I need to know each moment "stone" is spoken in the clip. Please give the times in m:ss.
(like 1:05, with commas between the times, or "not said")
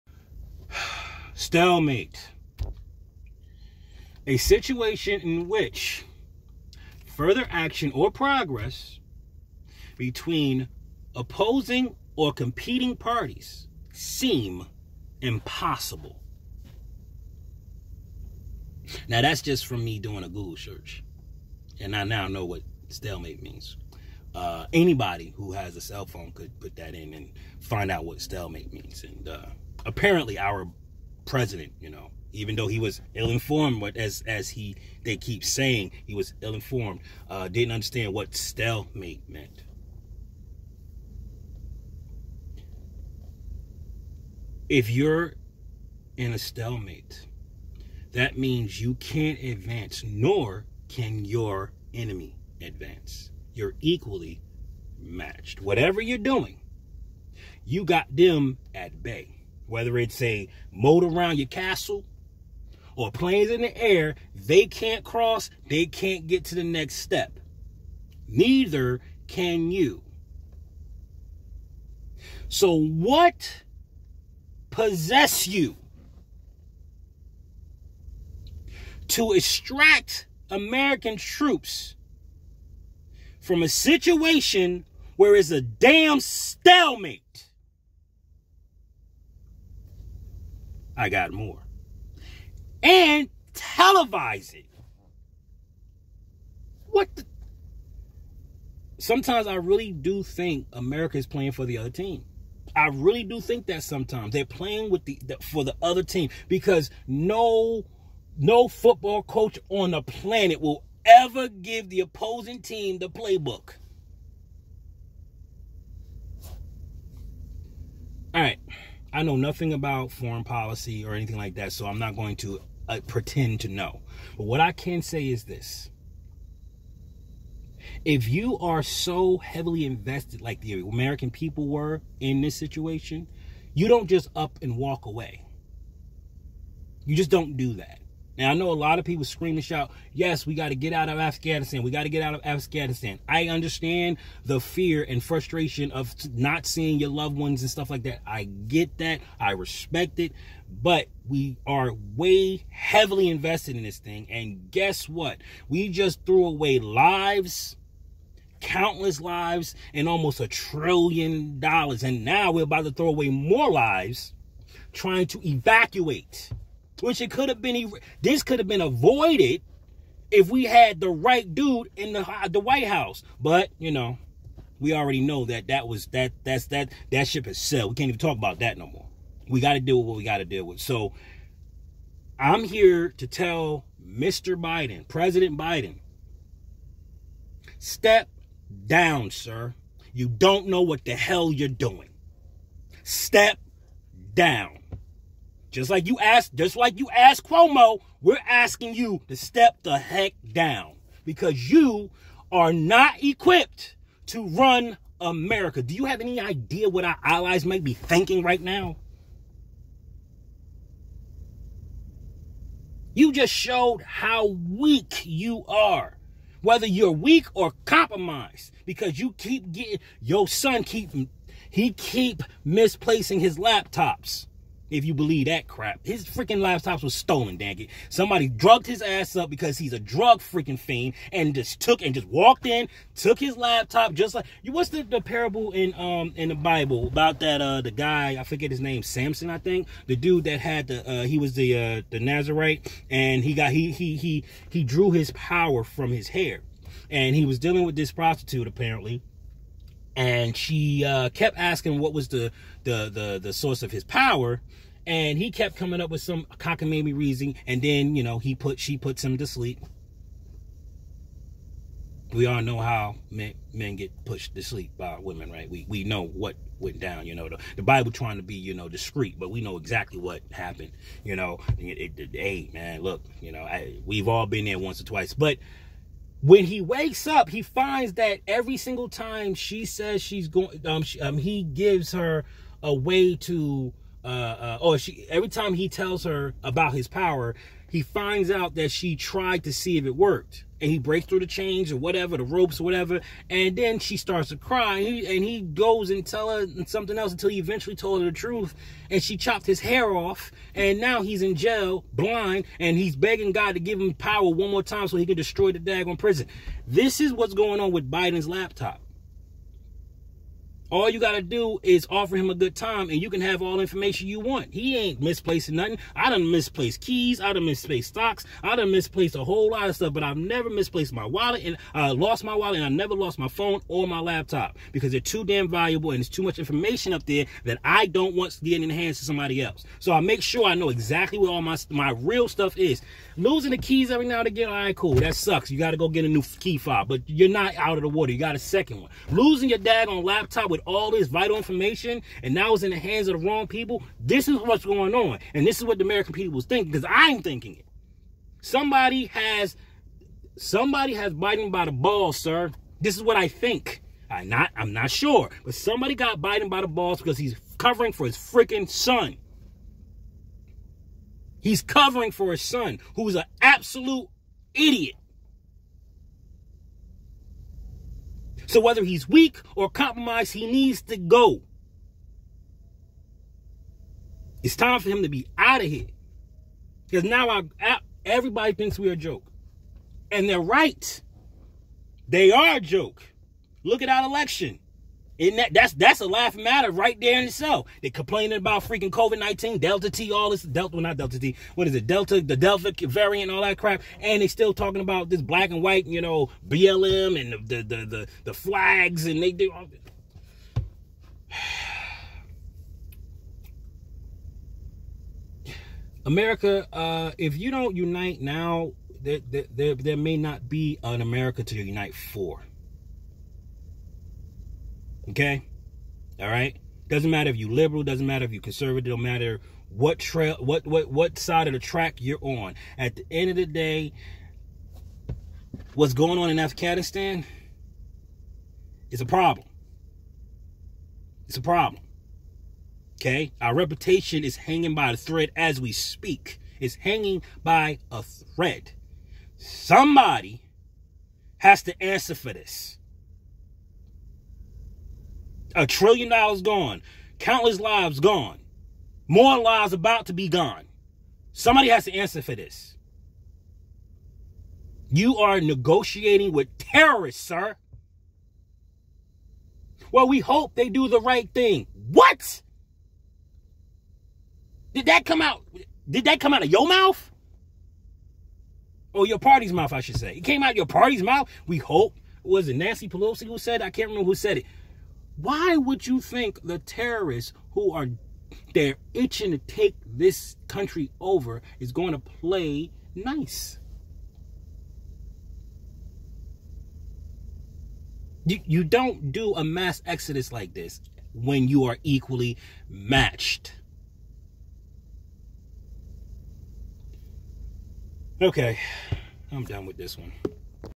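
not said.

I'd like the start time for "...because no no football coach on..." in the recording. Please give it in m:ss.
1:46.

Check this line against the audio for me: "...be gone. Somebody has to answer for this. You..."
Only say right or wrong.
right.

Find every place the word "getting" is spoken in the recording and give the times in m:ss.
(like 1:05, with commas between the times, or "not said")
3:39, 5:28.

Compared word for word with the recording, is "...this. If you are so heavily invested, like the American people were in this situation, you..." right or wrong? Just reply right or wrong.
right.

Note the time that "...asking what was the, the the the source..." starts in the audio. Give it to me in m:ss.
4:11.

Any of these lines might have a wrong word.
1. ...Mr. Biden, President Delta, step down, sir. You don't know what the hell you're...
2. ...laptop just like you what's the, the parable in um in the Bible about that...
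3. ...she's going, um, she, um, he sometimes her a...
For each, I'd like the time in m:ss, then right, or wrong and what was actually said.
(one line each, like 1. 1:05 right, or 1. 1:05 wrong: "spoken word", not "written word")
1. 3:04 wrong: "Biden", not "Delta"
2. 3:53 right
3. 4:40 wrong: "gives", not "sometimes".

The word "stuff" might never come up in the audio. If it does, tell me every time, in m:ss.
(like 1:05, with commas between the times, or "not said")
2:27, 5:19, 5:32.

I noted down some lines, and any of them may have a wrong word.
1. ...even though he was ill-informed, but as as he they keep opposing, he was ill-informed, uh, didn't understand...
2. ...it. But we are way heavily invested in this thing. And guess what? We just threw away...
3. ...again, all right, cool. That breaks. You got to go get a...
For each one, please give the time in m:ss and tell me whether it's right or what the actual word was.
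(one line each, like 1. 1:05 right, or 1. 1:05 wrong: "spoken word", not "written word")
1. 0:32 wrong: "saying", not "opposing"
2. 2:30 right
3. 5:34 wrong: "sucks", not "breaks".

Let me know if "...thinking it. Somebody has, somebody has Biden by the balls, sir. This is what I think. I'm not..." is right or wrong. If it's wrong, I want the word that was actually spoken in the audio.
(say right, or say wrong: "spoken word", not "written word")
right.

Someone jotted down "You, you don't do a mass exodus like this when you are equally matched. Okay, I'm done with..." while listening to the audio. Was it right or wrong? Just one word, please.
right.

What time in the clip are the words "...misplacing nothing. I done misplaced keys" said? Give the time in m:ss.
5:15.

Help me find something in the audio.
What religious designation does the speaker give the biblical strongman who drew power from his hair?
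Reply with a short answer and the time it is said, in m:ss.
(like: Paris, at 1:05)
Nazarite, at 4:02.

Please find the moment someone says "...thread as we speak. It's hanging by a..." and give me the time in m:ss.
7:15.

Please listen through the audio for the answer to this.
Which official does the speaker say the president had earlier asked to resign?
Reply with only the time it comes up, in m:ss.
3:17.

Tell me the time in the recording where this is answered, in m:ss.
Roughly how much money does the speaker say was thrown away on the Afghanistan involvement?
2:40.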